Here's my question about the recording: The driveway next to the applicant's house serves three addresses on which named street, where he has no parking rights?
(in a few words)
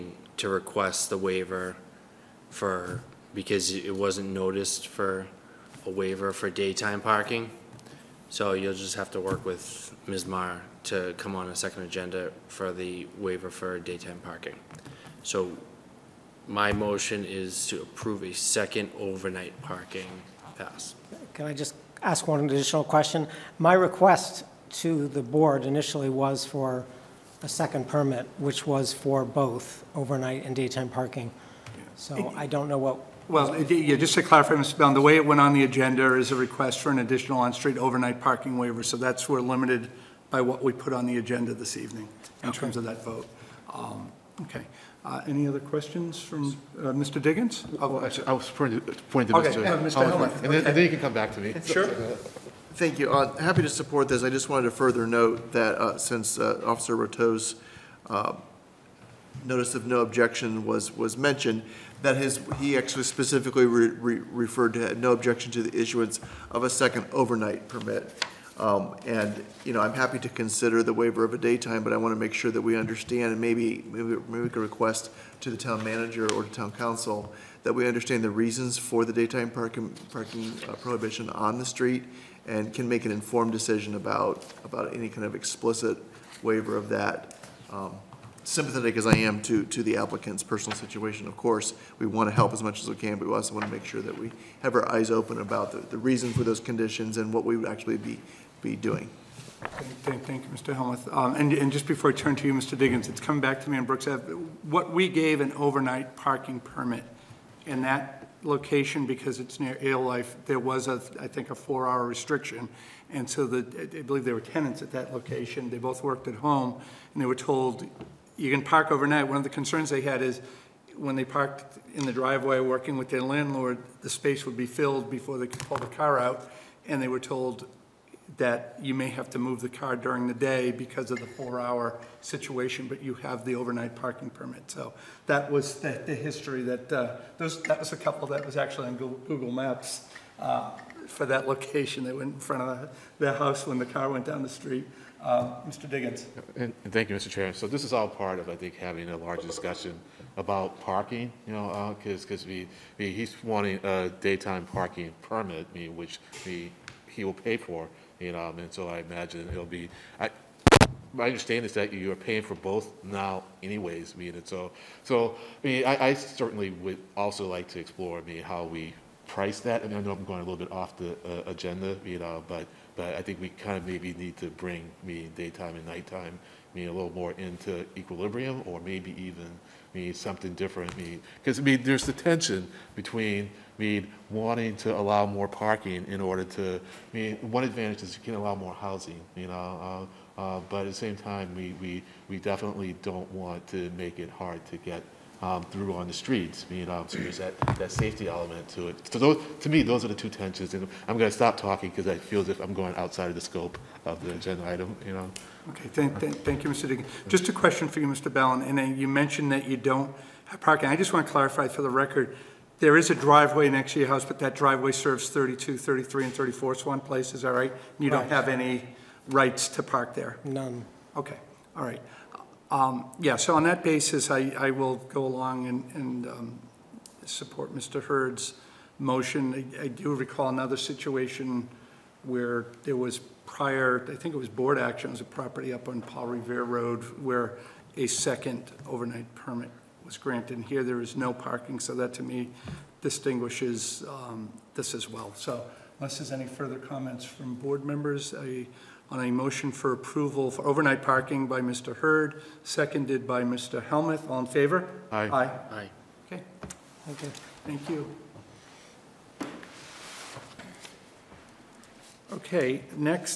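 Swan Place.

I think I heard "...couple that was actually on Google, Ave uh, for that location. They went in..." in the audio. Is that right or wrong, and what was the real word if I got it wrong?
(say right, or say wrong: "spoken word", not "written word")
wrong: "Maps", not "Ave".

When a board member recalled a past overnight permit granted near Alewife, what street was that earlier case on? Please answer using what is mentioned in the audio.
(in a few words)
Brooks Ave.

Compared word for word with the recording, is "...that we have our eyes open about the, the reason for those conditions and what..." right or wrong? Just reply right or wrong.
right.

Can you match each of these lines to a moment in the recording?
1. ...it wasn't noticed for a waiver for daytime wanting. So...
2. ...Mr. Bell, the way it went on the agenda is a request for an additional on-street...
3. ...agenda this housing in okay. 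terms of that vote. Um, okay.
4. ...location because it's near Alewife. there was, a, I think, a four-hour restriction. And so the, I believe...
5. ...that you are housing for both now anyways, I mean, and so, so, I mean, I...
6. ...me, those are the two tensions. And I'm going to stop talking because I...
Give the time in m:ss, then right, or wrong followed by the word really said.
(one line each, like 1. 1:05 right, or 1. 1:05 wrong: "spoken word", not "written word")
1. 0:03 wrong: "parking", not "wanting"
2. 0:34 right
3. 0:41 wrong: "evening", not "housing"
4. 1:48 right
5. 2:41 wrong: "paying", not "housing"
6. 3:19 right.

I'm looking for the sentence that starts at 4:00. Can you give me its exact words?
And here there is no parking, so that to me distinguishes um, this as well.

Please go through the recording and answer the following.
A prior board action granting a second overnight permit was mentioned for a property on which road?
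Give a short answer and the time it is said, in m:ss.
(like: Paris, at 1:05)
Paul Revere Road, at 3:56.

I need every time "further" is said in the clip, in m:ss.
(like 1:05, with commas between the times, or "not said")
0:54, 4:06.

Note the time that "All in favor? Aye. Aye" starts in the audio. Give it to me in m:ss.
4:14.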